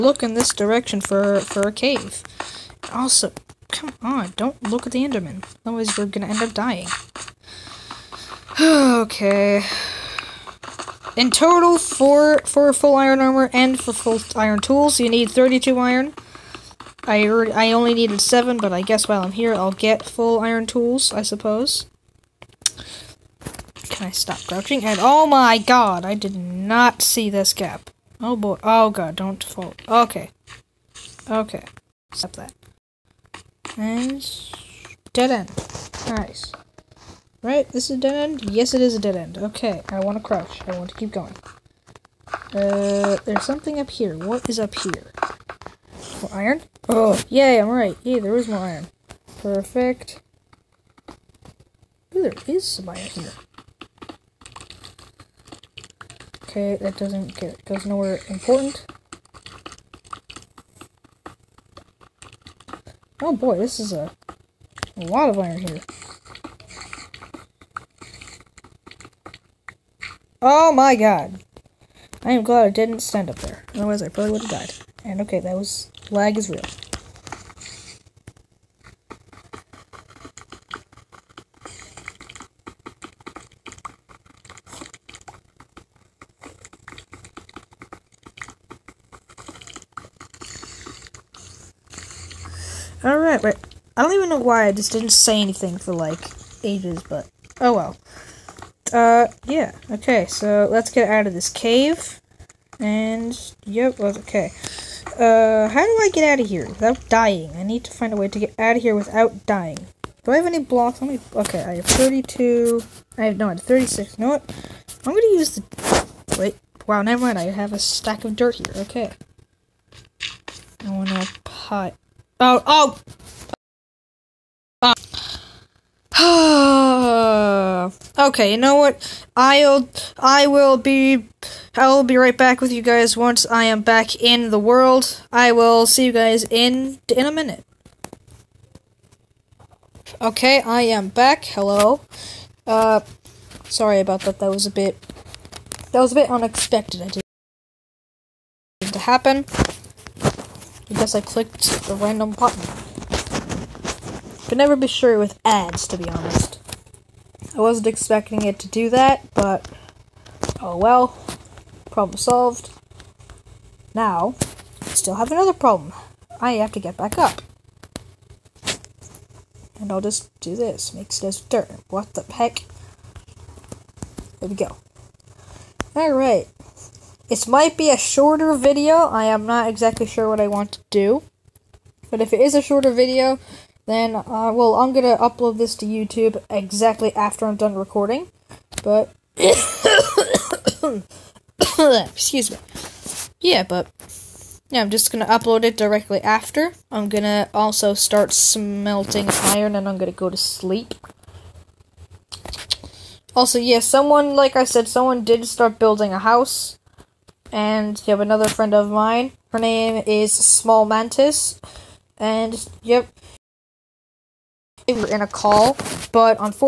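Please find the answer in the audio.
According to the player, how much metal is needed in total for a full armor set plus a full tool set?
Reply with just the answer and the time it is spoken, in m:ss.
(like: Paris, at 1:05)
32, at 0:15.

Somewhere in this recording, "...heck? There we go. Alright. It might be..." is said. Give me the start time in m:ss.
2:52.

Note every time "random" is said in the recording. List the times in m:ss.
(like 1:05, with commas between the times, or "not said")
2:31.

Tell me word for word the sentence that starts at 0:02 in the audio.
Also, come on, don't look at the Enderman.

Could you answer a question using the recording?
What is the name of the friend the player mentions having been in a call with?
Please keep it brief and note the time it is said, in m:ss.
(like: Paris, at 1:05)
Small Mantis, at 3:30.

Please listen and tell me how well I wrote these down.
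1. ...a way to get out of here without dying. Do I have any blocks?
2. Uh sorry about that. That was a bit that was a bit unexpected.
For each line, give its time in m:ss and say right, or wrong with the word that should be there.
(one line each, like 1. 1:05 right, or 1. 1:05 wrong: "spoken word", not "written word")
1. 1:48 right
2. 2:22 right.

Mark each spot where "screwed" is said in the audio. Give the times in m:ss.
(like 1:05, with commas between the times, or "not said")
not said.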